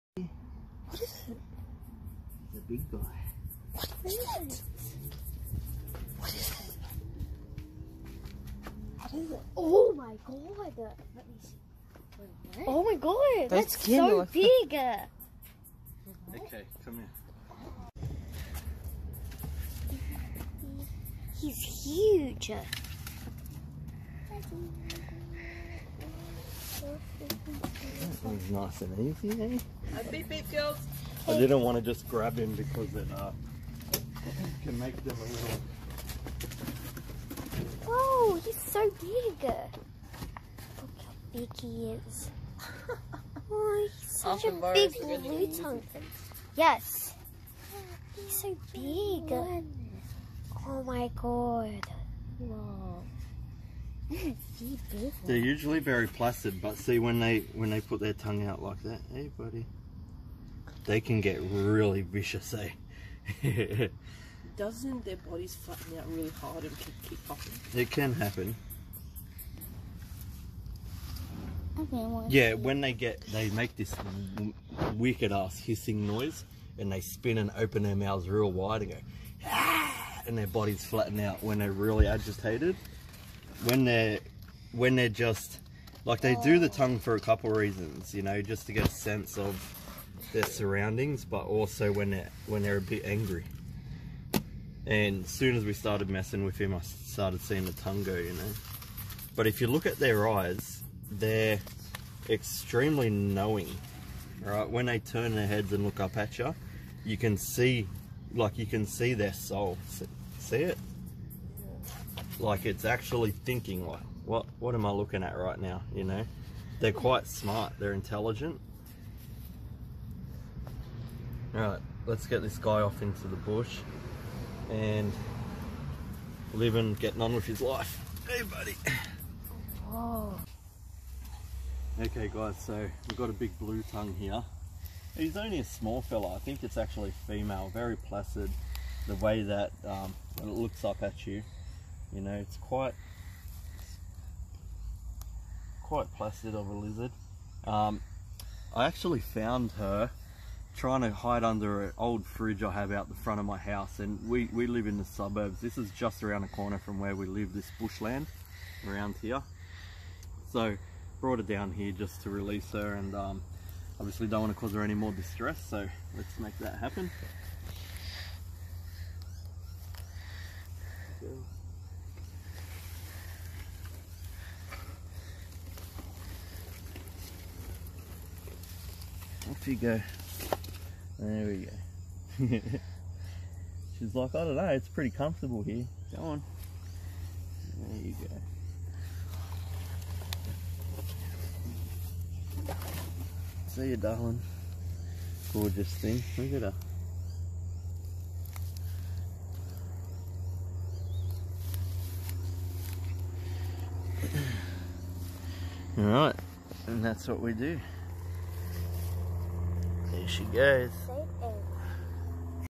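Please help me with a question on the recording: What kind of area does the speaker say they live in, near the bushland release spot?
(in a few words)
The suburbs.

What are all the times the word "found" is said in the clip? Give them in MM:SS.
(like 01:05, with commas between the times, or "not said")
02:29.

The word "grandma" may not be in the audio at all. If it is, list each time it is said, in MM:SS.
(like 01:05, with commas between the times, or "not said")
not said.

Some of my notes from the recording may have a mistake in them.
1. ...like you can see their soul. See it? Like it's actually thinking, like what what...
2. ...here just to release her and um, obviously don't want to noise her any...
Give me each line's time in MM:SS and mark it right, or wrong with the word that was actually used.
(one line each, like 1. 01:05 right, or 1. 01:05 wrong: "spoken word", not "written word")
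1. 01:48 right
2. 02:41 wrong: "cause", not "noise".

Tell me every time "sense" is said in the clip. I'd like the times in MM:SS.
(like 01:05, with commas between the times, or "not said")
01:28.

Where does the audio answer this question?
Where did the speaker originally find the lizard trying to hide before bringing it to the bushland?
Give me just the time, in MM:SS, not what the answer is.
02:31.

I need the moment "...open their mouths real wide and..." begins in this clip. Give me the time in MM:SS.
01:17.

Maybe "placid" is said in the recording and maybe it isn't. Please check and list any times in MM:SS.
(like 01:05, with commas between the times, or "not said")
00:56, 02:17, 02:26.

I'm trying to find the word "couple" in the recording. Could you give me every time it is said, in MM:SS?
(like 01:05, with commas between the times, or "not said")
01:27.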